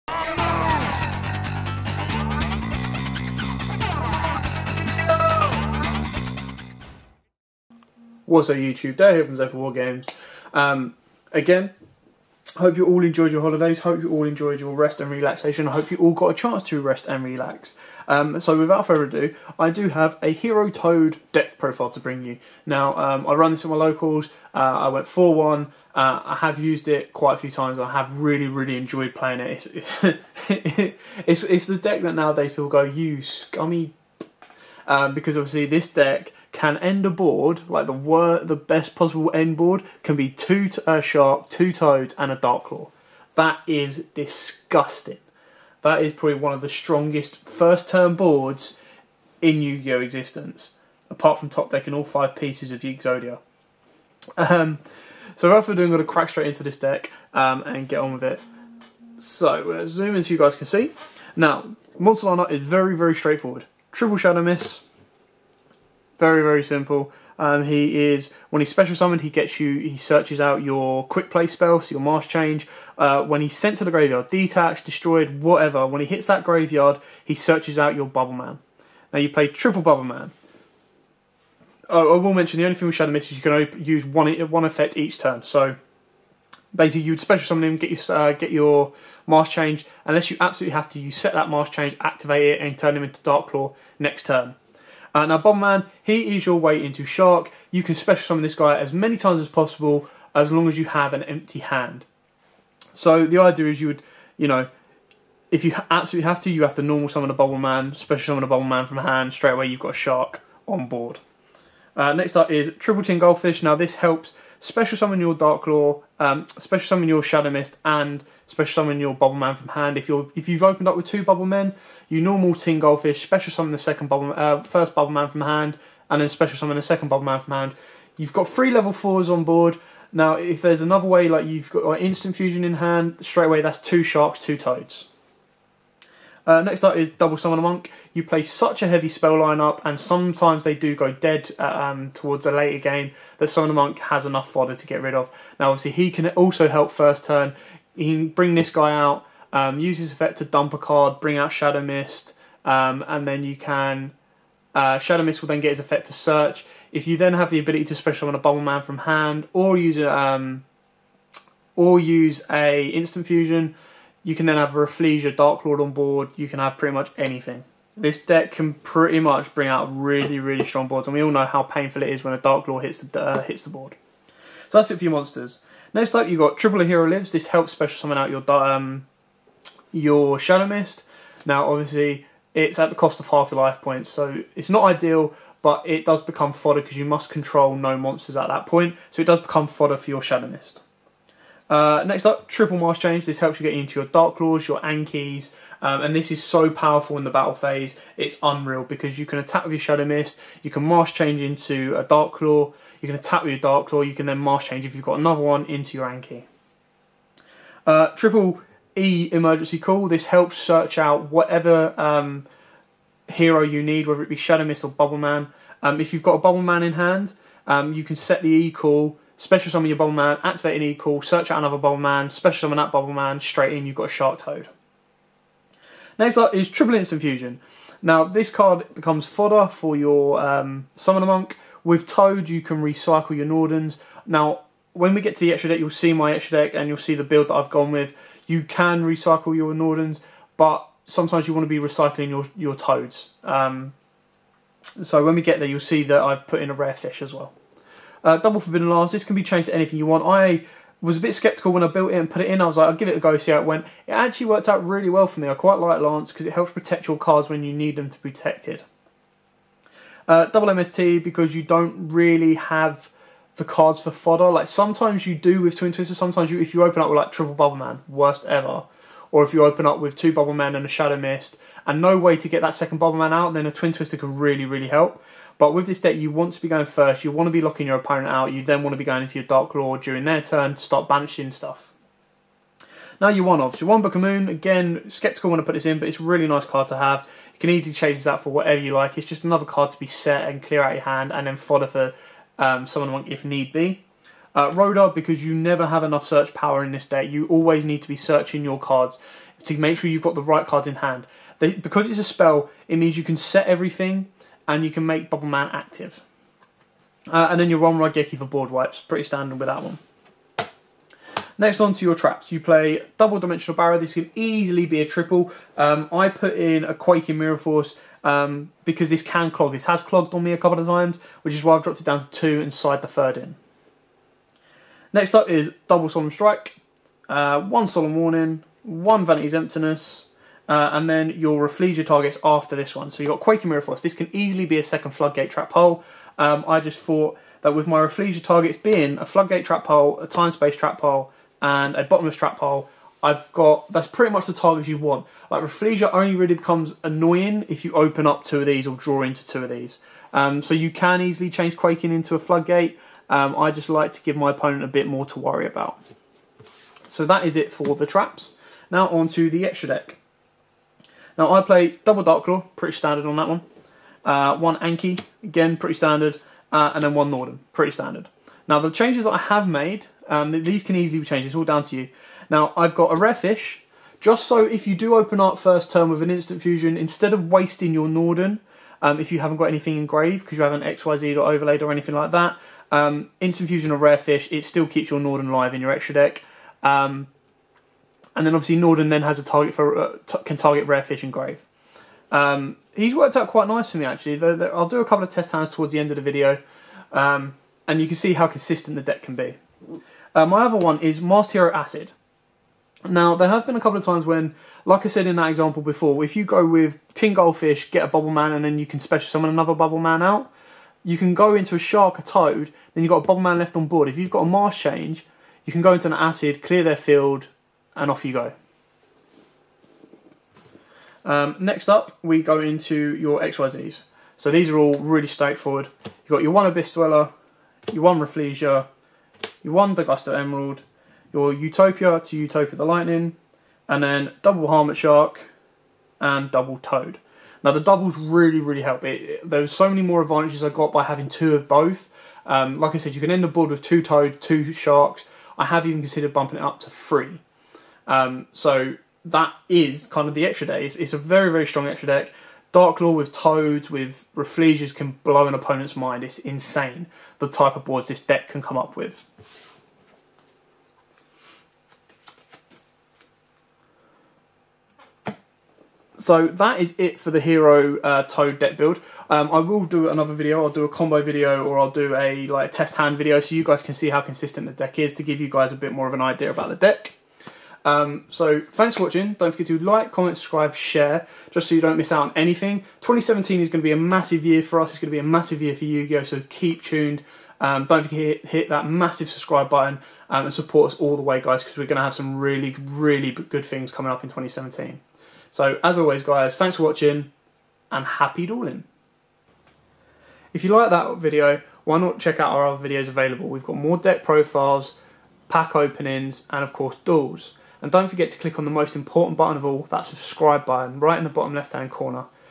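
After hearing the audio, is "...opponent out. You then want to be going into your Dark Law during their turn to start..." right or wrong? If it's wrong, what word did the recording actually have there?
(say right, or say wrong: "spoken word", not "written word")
right.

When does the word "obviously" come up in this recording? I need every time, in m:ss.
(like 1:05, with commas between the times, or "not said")
0:35, 2:25, 3:01, 6:28.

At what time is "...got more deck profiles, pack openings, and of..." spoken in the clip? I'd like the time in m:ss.
8:23.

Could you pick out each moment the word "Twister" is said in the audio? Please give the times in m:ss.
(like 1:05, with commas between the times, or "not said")
4:25, 4:33.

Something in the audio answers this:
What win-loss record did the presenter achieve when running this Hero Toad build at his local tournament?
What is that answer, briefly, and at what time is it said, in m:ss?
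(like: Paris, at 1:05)
4-1, at 0:25.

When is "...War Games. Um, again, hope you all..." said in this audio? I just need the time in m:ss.
0:09.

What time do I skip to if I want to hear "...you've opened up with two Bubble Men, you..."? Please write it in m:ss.
2:00.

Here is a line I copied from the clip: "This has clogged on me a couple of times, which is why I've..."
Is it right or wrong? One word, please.
right.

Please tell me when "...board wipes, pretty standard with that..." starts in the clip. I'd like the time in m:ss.
5:08.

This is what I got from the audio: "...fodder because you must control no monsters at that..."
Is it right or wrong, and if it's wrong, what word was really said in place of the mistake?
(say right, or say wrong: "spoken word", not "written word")
right.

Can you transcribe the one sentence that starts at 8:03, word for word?
2017 is going to be a massive year for us.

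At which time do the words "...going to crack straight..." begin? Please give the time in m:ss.
0:55.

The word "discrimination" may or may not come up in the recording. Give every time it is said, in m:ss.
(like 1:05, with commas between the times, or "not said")
not said.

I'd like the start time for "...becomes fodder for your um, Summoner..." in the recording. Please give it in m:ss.
3:48.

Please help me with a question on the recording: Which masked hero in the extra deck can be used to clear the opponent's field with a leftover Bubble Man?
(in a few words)
Masked Hero Acid.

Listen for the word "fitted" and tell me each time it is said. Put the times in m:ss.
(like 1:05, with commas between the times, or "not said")
not said.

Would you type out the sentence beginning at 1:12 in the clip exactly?
Uh, when he's sent to the graveyard, detached, destroyed, whatever.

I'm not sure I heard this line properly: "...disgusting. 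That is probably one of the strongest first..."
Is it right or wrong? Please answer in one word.
right.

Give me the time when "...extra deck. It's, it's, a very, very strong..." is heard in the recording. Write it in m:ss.
7:30.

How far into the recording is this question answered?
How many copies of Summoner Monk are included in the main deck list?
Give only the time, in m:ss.
2:17.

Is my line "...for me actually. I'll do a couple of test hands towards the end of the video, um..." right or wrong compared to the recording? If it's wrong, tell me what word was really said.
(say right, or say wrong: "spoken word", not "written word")
right.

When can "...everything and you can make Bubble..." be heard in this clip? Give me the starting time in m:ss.
5:03.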